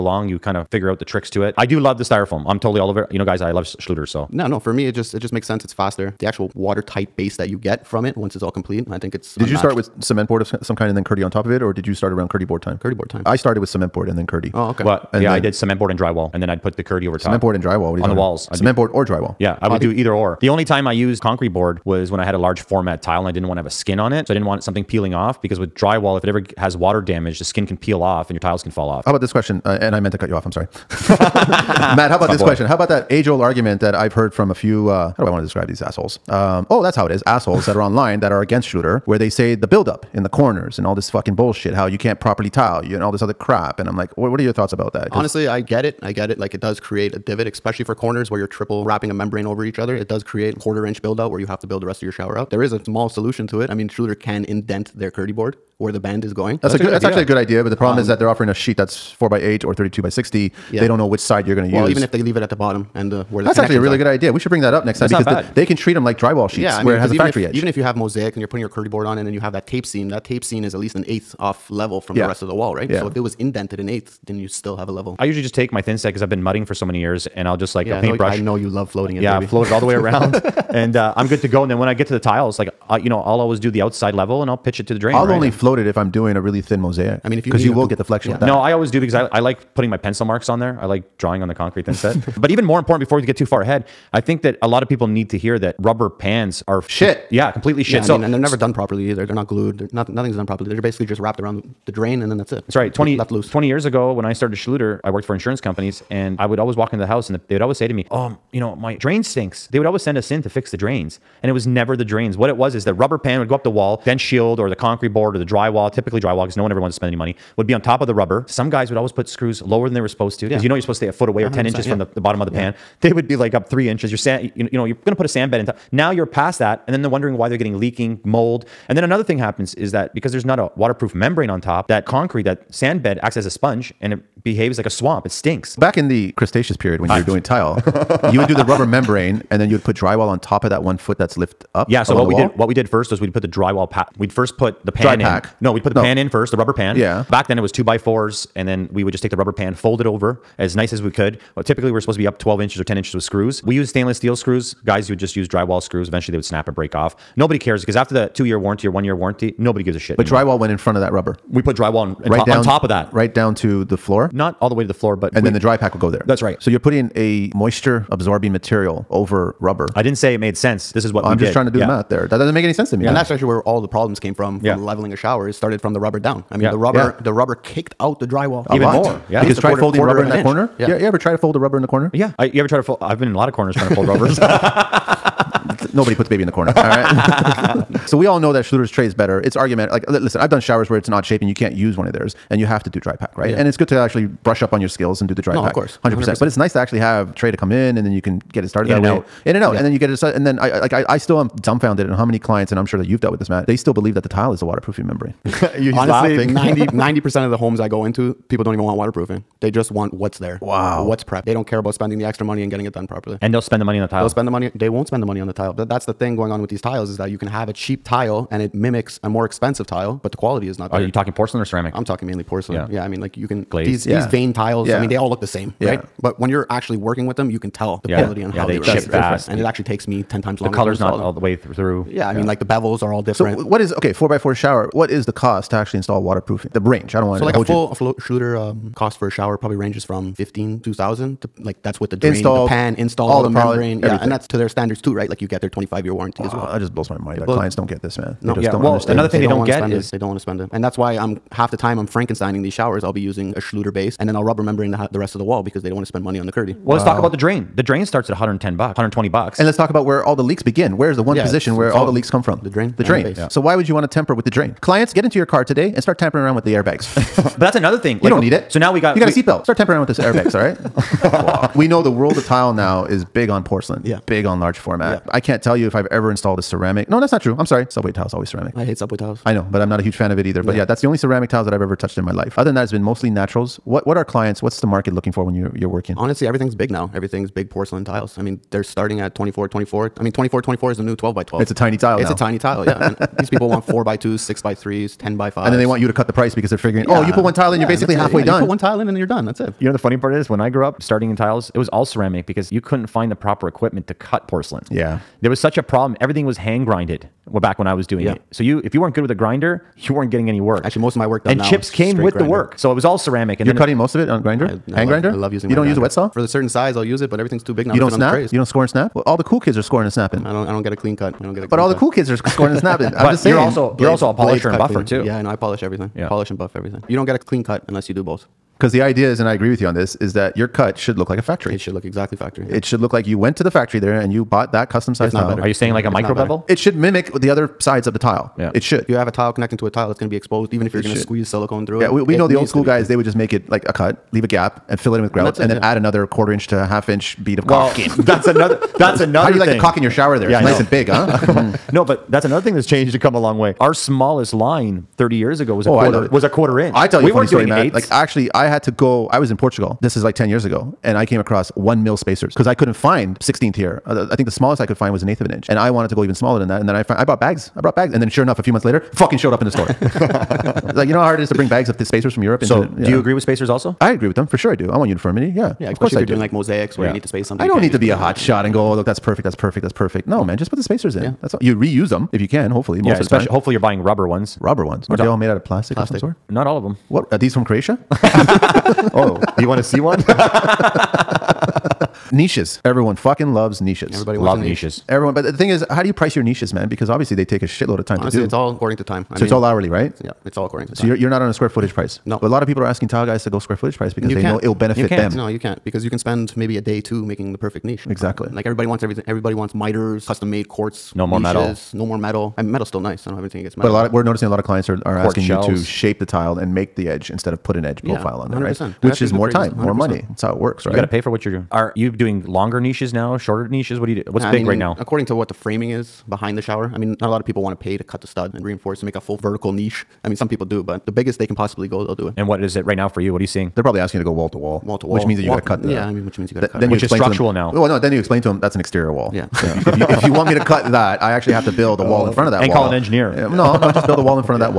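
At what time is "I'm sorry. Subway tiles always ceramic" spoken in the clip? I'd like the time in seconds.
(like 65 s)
277 s.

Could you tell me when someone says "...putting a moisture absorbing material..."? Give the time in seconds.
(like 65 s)
166 s.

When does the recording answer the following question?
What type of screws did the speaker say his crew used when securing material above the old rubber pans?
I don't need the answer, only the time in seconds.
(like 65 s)
153 s.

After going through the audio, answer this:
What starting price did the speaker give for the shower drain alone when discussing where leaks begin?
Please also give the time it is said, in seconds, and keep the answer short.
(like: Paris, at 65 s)
$110, at 258 s.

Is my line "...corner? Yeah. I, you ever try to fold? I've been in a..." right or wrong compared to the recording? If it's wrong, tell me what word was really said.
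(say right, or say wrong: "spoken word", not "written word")
right.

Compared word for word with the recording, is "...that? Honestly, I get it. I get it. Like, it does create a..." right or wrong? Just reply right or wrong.
right.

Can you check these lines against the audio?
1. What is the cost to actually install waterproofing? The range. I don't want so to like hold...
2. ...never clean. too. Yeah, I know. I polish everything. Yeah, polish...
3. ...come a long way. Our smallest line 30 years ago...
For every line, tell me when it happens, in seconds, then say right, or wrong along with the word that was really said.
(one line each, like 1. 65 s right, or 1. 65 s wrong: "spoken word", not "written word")
1. 234 s right
2. 324 s wrong: "buffer", not "never"
3. 353 s right.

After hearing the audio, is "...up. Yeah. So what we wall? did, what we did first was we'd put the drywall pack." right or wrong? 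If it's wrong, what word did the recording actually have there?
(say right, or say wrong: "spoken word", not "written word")
right.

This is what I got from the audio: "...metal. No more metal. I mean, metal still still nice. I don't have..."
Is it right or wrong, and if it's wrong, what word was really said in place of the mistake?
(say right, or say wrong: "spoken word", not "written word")
right.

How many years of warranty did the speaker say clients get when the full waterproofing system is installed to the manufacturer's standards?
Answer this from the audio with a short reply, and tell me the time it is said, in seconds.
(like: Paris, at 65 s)
25, at 245 s.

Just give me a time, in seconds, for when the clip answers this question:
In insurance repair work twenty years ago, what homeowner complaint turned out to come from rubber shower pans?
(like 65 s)
108 s.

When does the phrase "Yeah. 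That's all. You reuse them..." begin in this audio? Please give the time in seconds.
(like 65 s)
381 s.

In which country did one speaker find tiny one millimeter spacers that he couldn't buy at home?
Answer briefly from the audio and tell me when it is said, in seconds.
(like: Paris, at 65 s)
Portugal, at 359 s.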